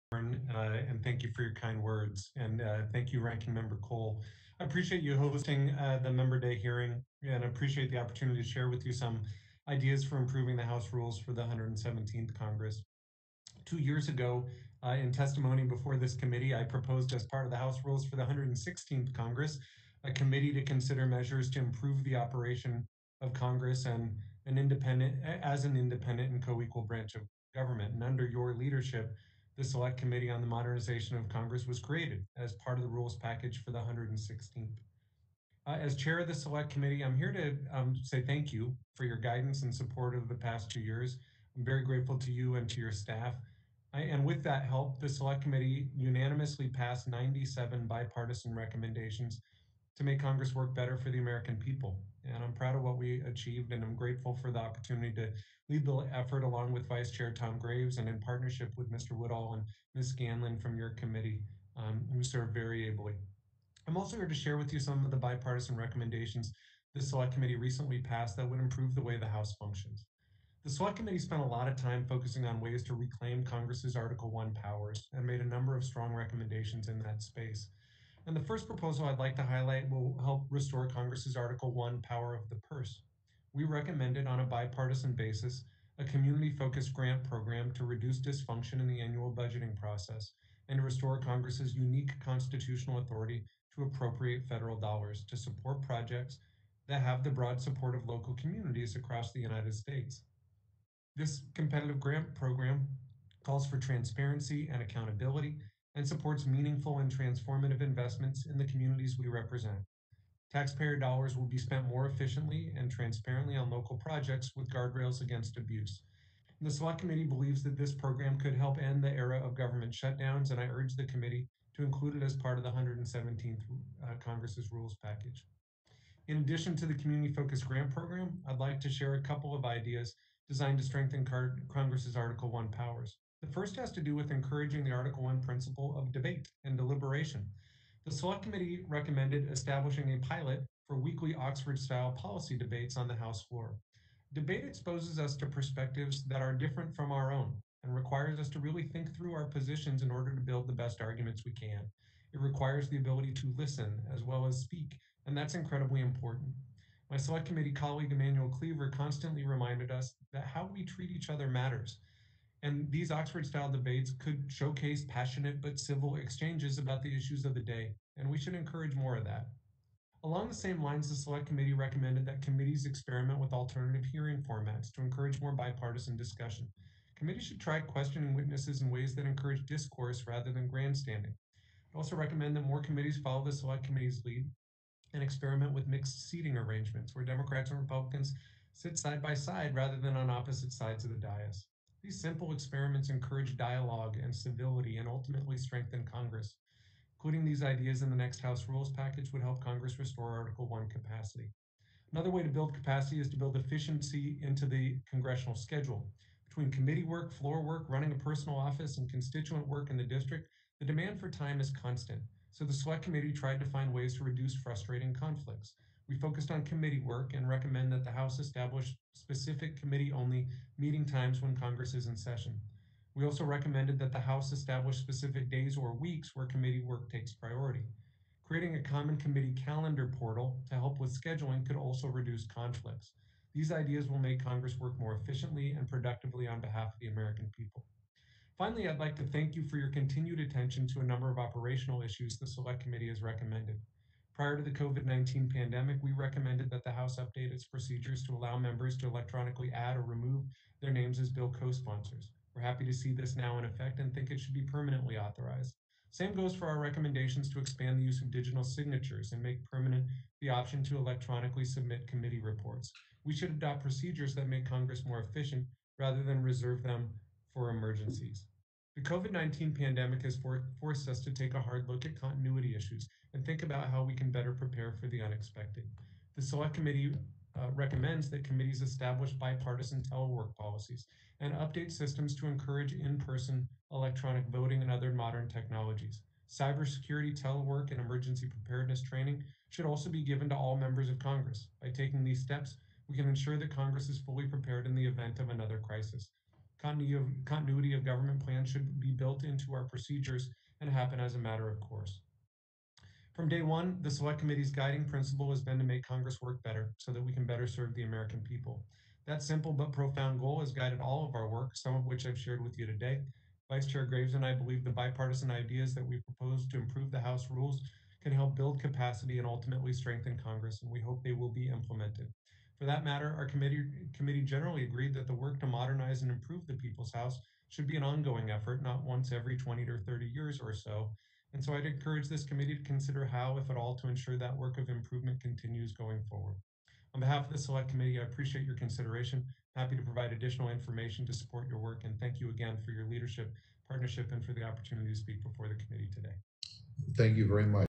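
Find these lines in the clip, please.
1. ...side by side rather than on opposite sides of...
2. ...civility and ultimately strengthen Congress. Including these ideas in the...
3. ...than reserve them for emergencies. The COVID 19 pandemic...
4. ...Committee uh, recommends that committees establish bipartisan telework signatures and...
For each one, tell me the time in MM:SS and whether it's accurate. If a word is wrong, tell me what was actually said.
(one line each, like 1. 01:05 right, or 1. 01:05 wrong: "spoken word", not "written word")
1. 03:08 right
2. 03:14 right
3. 04:26 right
4. 04:36 wrong: "policies", not "signatures".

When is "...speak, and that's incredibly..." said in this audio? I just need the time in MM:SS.
02:34.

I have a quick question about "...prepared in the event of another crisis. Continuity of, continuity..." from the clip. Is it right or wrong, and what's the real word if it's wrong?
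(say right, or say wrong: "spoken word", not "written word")
right.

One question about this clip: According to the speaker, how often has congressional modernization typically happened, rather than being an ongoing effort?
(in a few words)
every 20 to 30 years.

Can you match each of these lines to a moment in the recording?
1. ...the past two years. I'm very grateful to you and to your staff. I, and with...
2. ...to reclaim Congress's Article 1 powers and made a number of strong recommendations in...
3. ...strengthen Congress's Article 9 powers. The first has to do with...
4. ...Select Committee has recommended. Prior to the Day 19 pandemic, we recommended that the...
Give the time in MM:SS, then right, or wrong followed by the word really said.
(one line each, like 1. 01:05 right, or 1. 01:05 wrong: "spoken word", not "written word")
1. 00:40 right
2. 01:12 right
3. 02:10 wrong: "1", not "9"
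4. 04:02 wrong: "COVID", not "Day".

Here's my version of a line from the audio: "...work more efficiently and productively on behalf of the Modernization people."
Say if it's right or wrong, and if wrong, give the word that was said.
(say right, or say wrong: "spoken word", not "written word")
wrong: "American", not "Modernization".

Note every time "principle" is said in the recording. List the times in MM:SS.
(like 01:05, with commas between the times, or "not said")
02:15, 05:05.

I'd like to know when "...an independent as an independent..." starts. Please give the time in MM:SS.
00:24.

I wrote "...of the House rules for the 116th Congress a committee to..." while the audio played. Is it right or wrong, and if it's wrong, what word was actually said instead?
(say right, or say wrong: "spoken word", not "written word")
right.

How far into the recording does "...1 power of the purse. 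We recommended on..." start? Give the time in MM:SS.
01:21.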